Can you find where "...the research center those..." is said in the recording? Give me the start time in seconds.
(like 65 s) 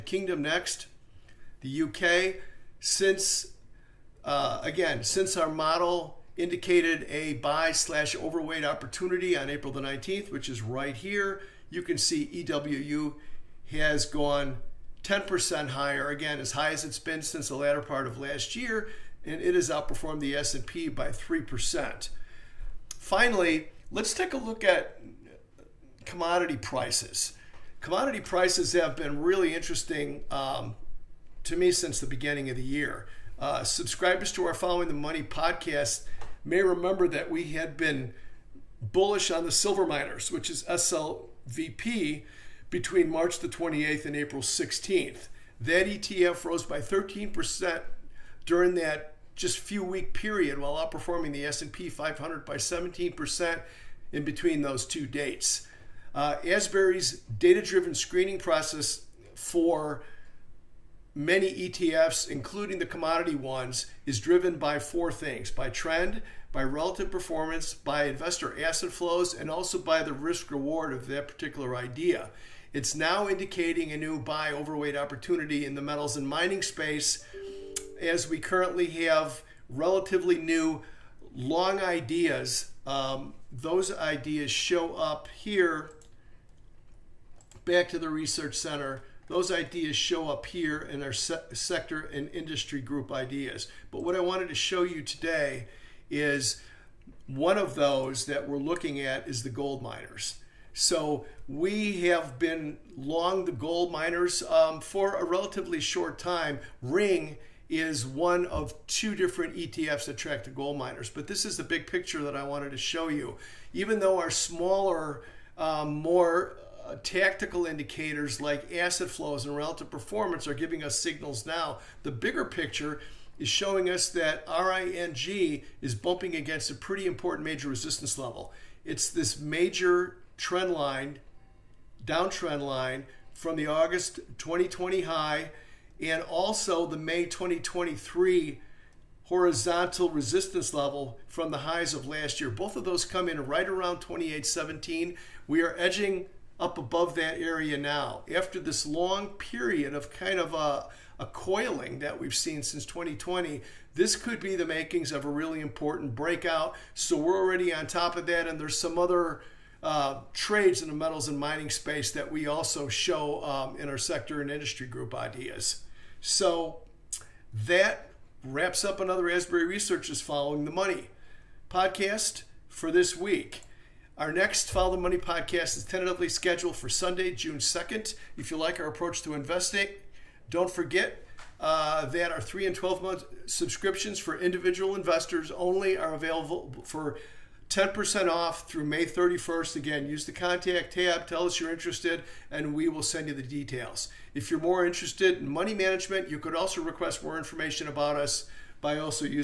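87 s.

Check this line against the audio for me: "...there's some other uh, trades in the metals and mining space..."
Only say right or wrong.
right.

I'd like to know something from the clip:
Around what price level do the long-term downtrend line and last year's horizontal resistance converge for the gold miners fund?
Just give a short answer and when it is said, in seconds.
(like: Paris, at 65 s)
2817, at 143 s.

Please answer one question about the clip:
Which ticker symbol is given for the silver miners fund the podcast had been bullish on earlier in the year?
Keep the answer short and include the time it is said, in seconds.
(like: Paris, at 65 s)
SLVP, at 40 s.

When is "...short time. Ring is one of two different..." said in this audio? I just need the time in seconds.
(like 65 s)
105 s.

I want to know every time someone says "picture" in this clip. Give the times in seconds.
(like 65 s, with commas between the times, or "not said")
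111 s, 122 s.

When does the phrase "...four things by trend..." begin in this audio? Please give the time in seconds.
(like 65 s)
64 s.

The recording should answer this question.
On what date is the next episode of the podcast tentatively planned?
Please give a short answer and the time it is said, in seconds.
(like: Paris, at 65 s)
Sunday, June 2nd, at 176 s.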